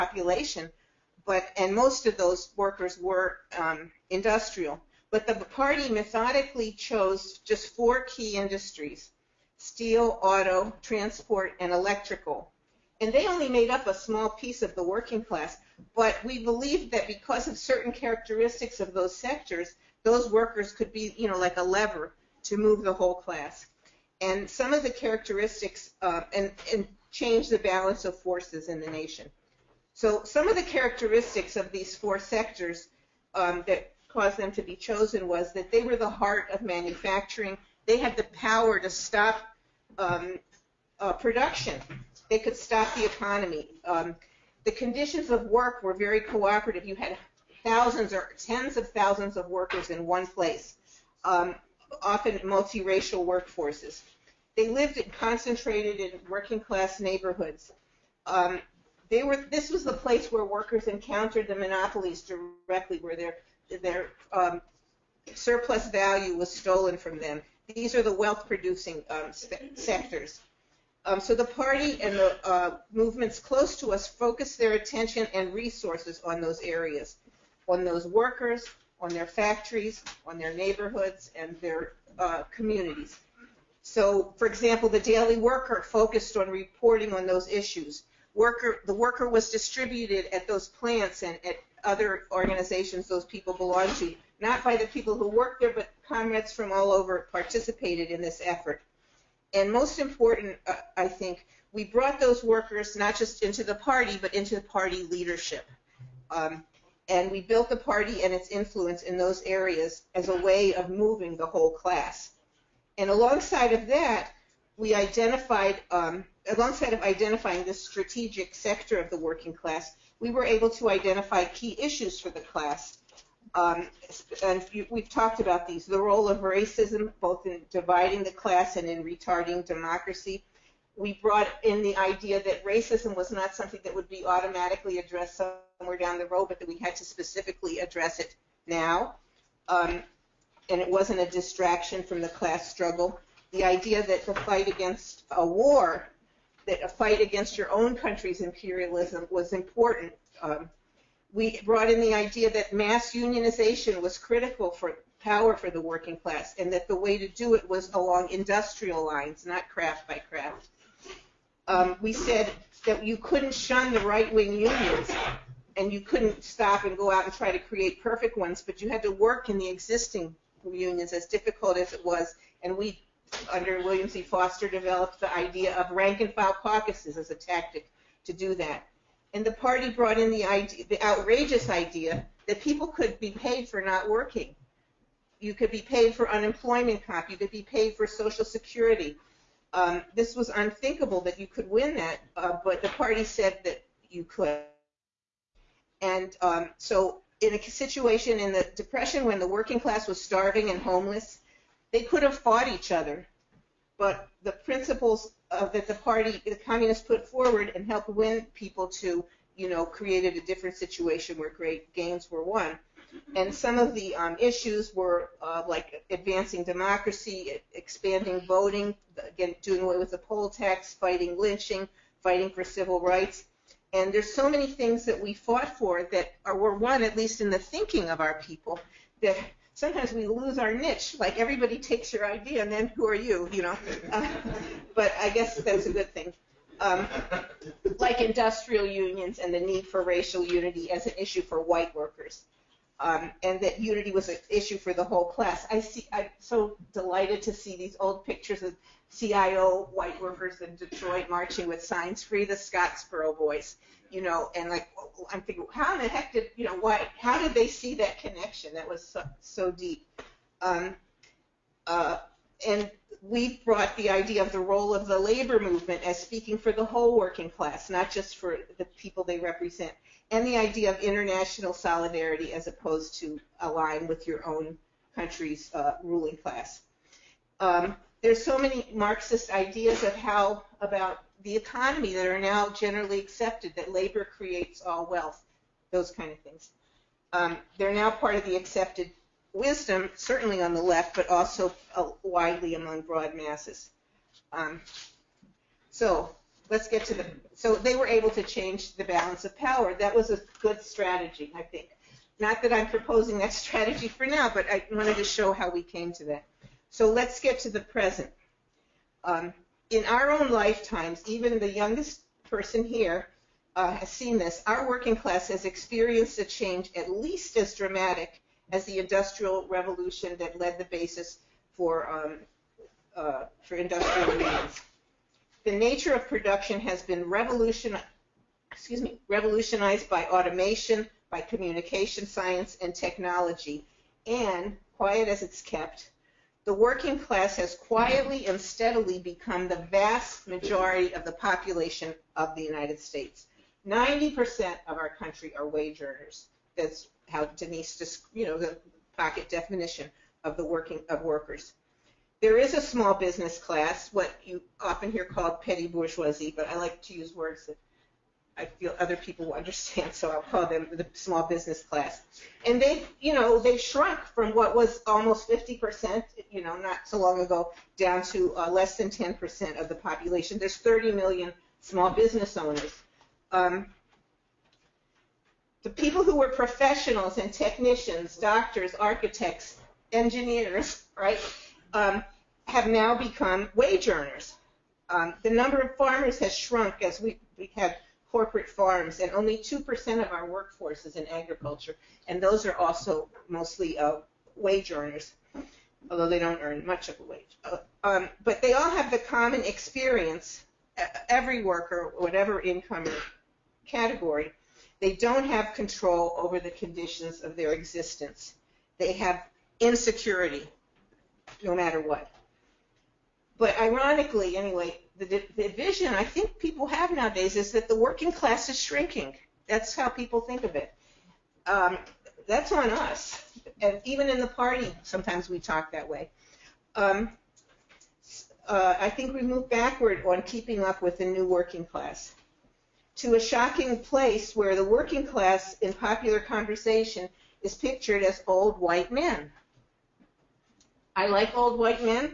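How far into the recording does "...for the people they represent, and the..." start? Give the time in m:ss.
4:28.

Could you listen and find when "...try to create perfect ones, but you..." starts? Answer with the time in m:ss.
2:47.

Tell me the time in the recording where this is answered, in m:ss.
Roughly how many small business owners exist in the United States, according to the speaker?
6:10.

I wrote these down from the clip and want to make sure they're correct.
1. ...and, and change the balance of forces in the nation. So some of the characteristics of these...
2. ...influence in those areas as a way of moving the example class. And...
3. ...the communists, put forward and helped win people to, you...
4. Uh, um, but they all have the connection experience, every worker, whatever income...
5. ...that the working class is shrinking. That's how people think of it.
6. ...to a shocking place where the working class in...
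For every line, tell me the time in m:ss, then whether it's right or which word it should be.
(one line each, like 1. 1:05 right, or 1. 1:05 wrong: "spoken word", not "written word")
1. 0:26 right
2. 1:48 wrong: "whole", not "example"
3. 3:26 right
4. 6:37 wrong: "common", not "connection"
5. 6:57 right
6. 7:13 right.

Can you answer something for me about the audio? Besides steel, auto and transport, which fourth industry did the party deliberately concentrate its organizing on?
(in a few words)
Electrical.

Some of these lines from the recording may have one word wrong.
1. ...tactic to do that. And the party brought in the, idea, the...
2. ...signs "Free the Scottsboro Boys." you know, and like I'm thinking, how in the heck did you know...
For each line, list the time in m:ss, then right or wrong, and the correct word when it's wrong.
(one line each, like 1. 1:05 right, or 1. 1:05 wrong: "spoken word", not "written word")
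1. 2:57 right
2. 4:11 right.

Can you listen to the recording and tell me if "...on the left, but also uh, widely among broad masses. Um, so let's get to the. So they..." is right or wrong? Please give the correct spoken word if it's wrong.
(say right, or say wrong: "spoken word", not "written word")
right.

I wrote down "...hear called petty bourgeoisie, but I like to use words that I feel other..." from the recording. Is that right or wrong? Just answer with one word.
right.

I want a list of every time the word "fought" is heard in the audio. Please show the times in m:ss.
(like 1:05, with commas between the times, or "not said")
3:22, 3:45.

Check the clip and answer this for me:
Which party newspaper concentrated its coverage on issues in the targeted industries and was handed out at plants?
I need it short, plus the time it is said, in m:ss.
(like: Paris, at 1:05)
Daily Worker, at 1:24.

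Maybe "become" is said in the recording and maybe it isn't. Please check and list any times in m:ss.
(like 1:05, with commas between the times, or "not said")
5:39, 6:23.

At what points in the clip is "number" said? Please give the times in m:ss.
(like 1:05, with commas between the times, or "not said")
6:25.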